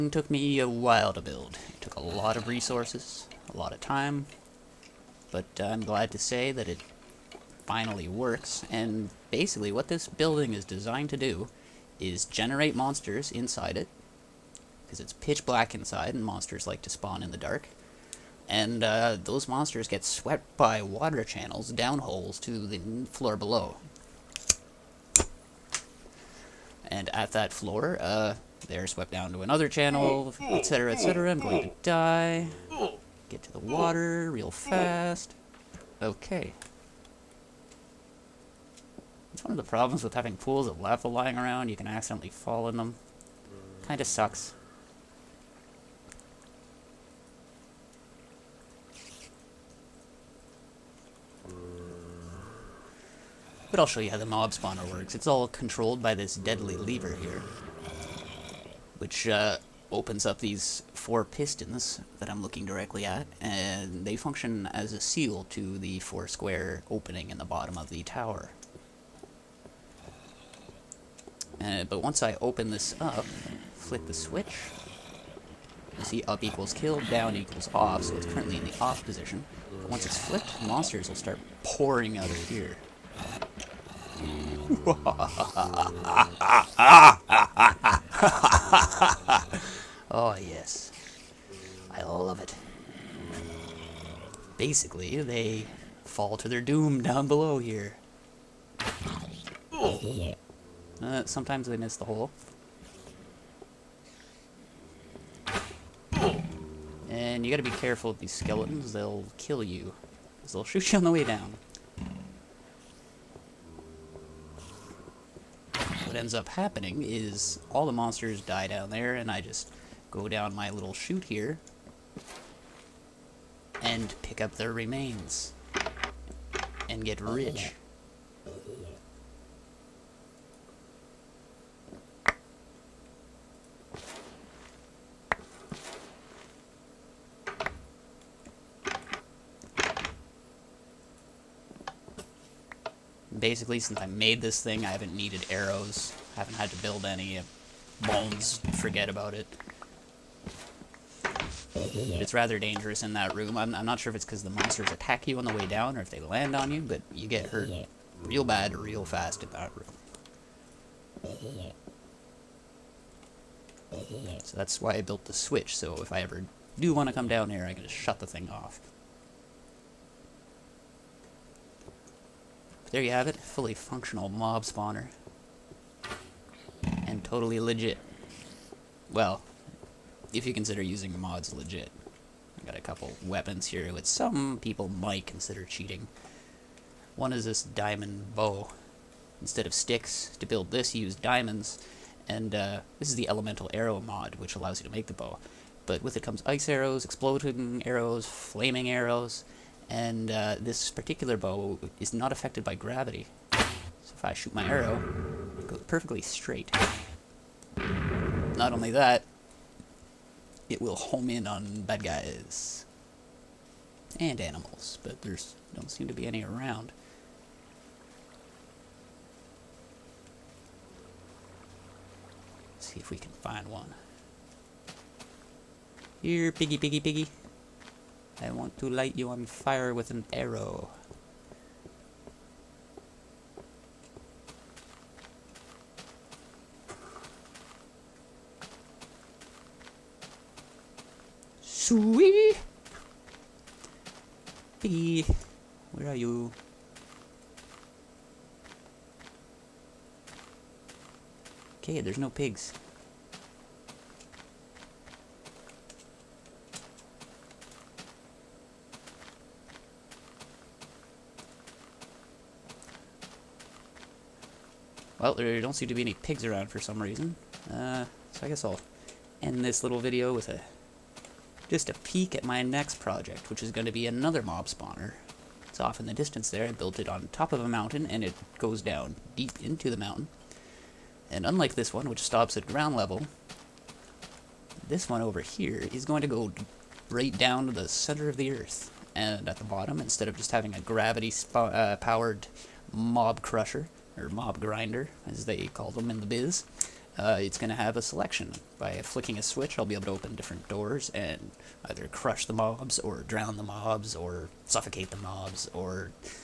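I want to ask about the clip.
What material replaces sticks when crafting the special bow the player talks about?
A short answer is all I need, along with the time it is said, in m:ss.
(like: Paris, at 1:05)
Diamonds, at 3:11.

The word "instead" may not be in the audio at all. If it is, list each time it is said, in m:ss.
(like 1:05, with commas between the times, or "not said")
3:09, 4:50.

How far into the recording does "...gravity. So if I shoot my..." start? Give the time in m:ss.
3:22.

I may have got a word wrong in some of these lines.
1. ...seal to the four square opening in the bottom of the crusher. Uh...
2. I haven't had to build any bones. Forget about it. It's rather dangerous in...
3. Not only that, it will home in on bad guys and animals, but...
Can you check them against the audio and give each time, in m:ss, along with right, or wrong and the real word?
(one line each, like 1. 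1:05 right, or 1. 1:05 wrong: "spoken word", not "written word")
1. 1:05 wrong: "tower", not "crusher"
2. 2:26 right
3. 3:28 right.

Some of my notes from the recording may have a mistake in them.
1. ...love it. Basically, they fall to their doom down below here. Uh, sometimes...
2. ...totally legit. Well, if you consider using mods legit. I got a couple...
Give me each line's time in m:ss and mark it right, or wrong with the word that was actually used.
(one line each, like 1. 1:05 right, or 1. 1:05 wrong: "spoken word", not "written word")
1. 1:32 right
2. 2:57 right.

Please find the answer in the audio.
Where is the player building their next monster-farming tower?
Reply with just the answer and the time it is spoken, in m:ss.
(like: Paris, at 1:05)
On top of a mountain, at 4:37.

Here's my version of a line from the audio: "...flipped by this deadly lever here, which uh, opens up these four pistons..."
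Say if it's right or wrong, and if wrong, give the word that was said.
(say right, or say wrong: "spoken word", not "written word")
wrong: "controlled", not "flipped".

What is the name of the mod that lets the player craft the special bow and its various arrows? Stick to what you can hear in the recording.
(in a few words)
Elemental arrow mod.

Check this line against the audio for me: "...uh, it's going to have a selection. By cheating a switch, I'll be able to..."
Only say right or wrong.
wrong.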